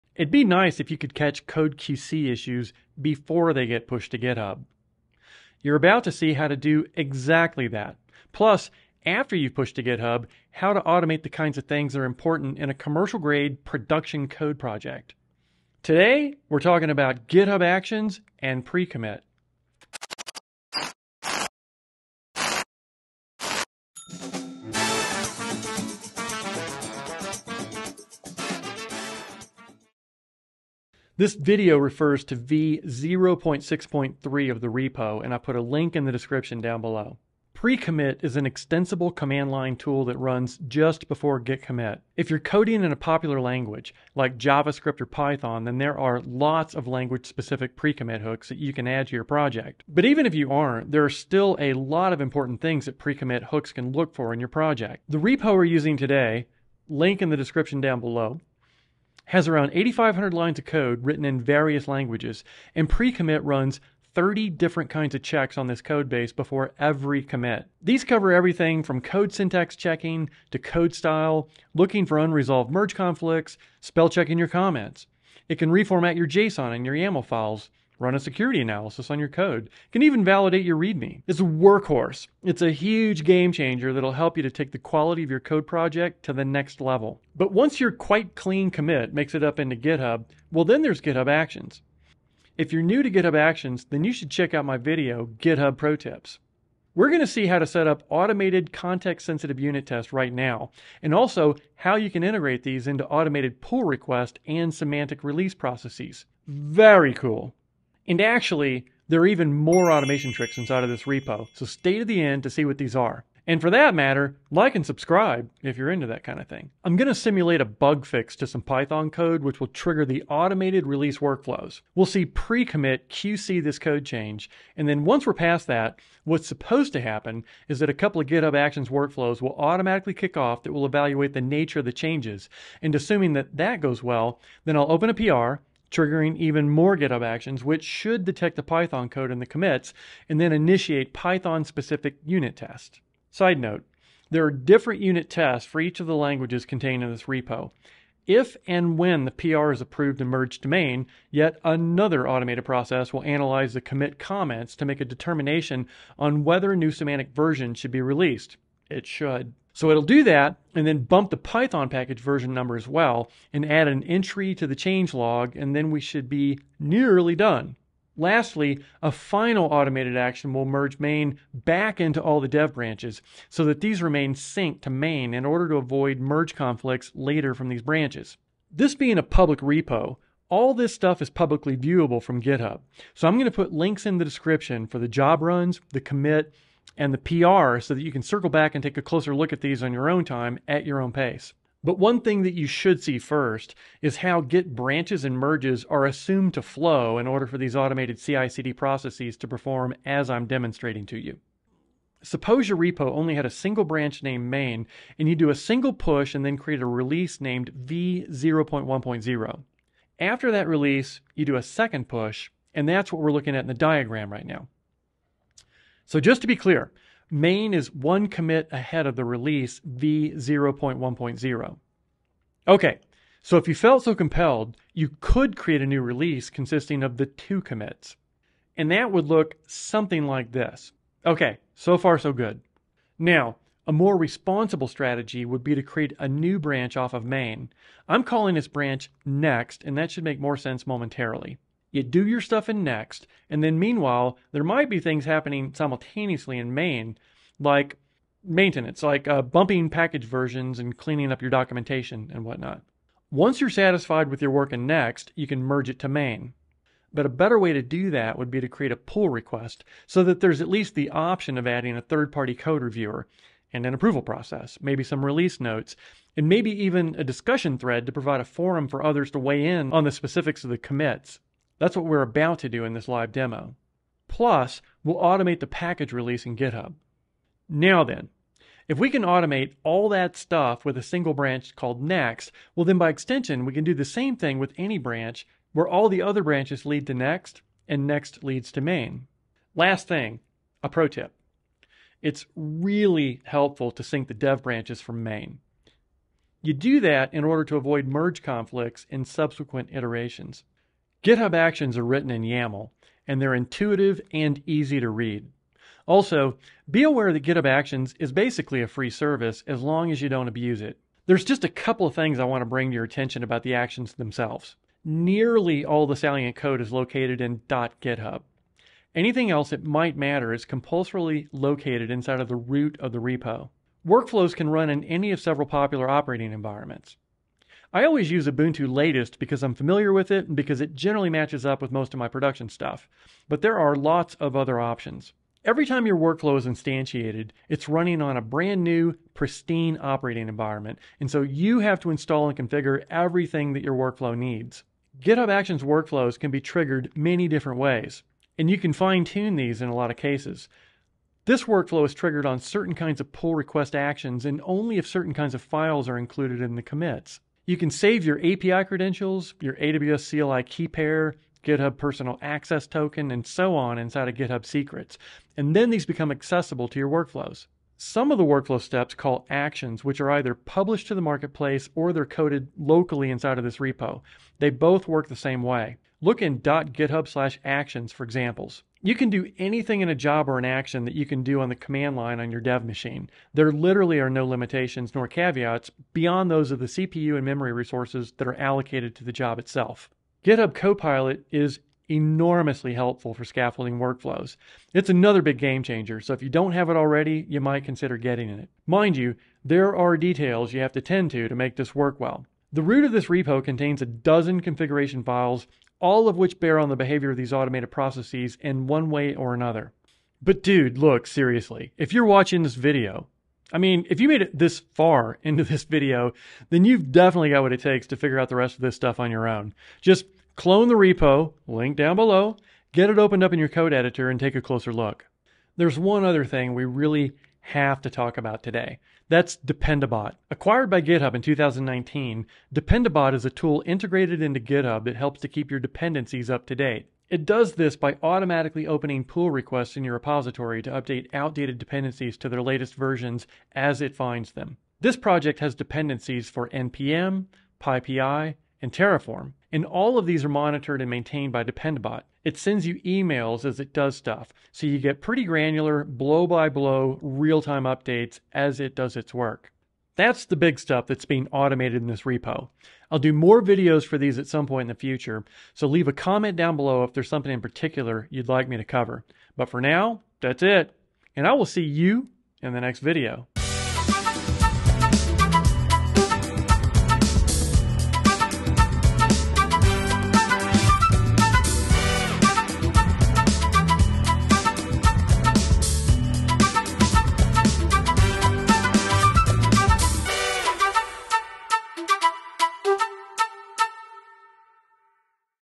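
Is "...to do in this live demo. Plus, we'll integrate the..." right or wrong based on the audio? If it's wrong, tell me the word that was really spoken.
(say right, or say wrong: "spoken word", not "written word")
wrong: "automate", not "integrate".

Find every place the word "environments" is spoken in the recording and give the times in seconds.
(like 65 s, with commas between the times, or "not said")
326 s, 340 s.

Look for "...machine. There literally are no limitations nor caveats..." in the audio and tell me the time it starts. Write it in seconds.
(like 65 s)
382 s.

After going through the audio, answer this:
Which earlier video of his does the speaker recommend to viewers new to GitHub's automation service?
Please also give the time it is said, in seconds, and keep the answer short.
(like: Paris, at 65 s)
GitHub Pro Tips, at 95 s.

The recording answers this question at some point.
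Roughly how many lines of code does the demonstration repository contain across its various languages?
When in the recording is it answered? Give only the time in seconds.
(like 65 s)
59 s.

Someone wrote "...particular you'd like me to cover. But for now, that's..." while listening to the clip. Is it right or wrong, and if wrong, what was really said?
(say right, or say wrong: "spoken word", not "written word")
right.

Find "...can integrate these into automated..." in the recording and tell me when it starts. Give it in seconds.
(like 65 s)
102 s.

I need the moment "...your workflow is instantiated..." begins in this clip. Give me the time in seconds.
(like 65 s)
336 s.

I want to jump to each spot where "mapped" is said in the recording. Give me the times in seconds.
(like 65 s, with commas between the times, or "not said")
not said.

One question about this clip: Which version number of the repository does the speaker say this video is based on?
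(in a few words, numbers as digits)
V0.6.3.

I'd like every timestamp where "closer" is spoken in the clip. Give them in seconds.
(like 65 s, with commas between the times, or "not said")
189 s, 424 s.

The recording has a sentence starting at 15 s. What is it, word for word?
Today, we're talking about GitHub Actions and pre commit.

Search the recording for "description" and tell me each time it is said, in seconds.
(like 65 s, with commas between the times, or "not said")
36 s, 57 s, 184 s.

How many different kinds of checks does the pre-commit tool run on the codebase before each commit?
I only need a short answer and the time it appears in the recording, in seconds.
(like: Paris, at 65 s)
30, at 64 s.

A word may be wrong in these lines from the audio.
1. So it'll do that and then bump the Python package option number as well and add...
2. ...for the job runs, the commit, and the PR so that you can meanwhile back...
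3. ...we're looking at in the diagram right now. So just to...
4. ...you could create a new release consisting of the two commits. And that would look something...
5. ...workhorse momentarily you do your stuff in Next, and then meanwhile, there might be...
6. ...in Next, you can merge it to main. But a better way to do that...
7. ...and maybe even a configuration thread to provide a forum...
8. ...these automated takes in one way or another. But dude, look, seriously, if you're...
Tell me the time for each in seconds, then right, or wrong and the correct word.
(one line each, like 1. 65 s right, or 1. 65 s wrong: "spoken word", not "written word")
1. 159 s wrong: "version", not "option"
2. 184 s wrong: "circle", not "meanwhile"
3. 213 s right
4. 224 s right
5. 240 s wrong: "sense", not "workhorse"
6. 254 s right
7. 266 s wrong: "discussion", not "configuration"
8. 407 s wrong: "processes", not "takes".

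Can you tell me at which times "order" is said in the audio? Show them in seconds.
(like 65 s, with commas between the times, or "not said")
175 s, 197 s, 297 s.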